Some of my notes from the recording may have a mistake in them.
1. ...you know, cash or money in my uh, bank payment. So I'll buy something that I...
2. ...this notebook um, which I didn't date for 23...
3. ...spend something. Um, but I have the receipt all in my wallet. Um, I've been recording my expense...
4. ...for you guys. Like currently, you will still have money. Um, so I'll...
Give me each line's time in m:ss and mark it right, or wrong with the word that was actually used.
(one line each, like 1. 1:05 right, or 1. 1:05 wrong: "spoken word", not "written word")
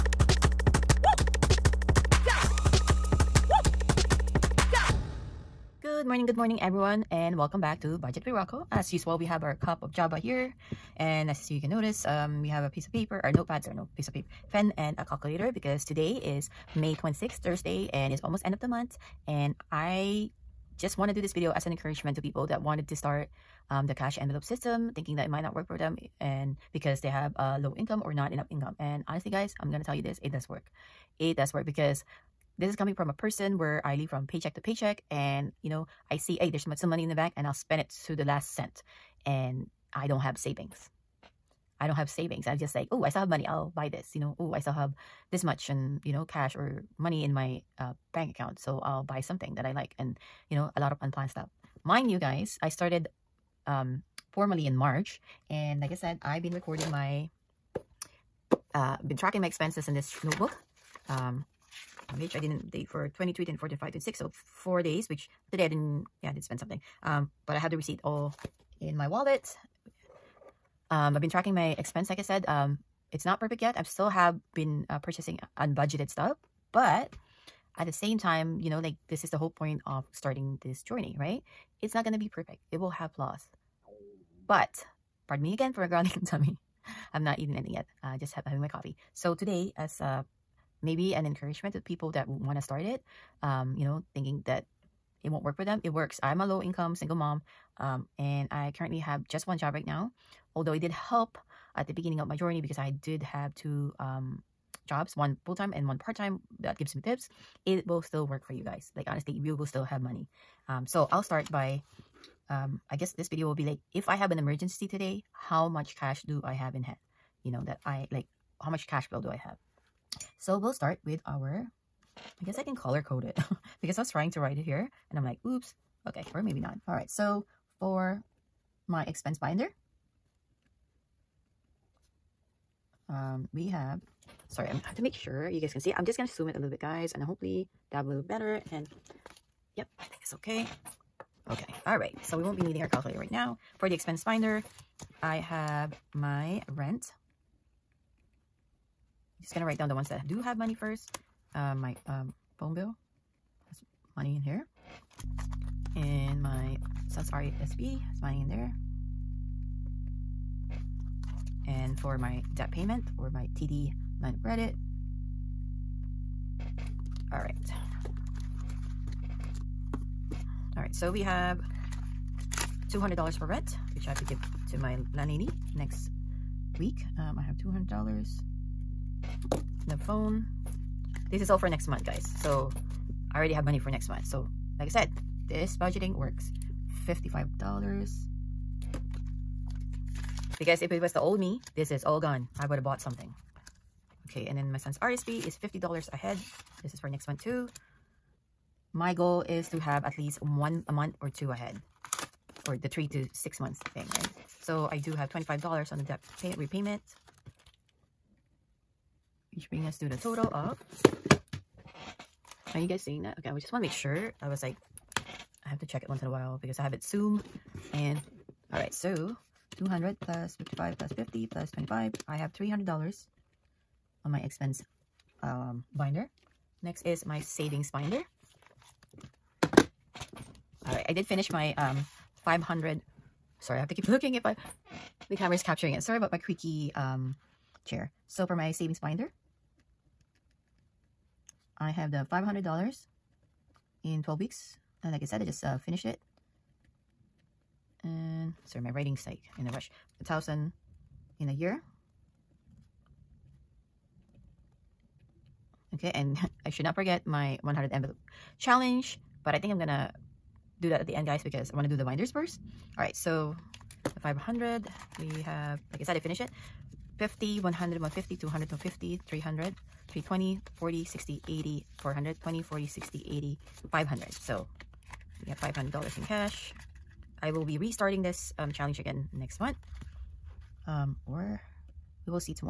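1. 0:46 wrong: "account", not "payment"
2. 0:59 right
3. 1:06 wrong: "tracking", not "recording"
4. 1:48 wrong: "honestly", not "currently".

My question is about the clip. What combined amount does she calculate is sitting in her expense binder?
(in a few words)
$300.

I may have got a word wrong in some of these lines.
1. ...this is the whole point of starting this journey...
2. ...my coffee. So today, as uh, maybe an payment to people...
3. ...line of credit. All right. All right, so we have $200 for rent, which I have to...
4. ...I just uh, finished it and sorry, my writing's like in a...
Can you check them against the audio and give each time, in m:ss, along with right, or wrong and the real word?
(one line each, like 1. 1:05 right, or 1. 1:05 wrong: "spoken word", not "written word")
1. 1:19 right
2. 1:28 wrong: "encouragement", not "payment"
3. 2:44 right
4. 4:05 right.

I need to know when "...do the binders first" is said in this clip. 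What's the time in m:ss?
4:21.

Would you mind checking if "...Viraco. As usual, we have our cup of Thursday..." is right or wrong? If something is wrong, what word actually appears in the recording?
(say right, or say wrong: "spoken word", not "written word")
wrong: "Java", not "Thursday".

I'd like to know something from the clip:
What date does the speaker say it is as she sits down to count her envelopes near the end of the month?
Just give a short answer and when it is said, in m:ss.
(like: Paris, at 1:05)
May 26th, at 0:16.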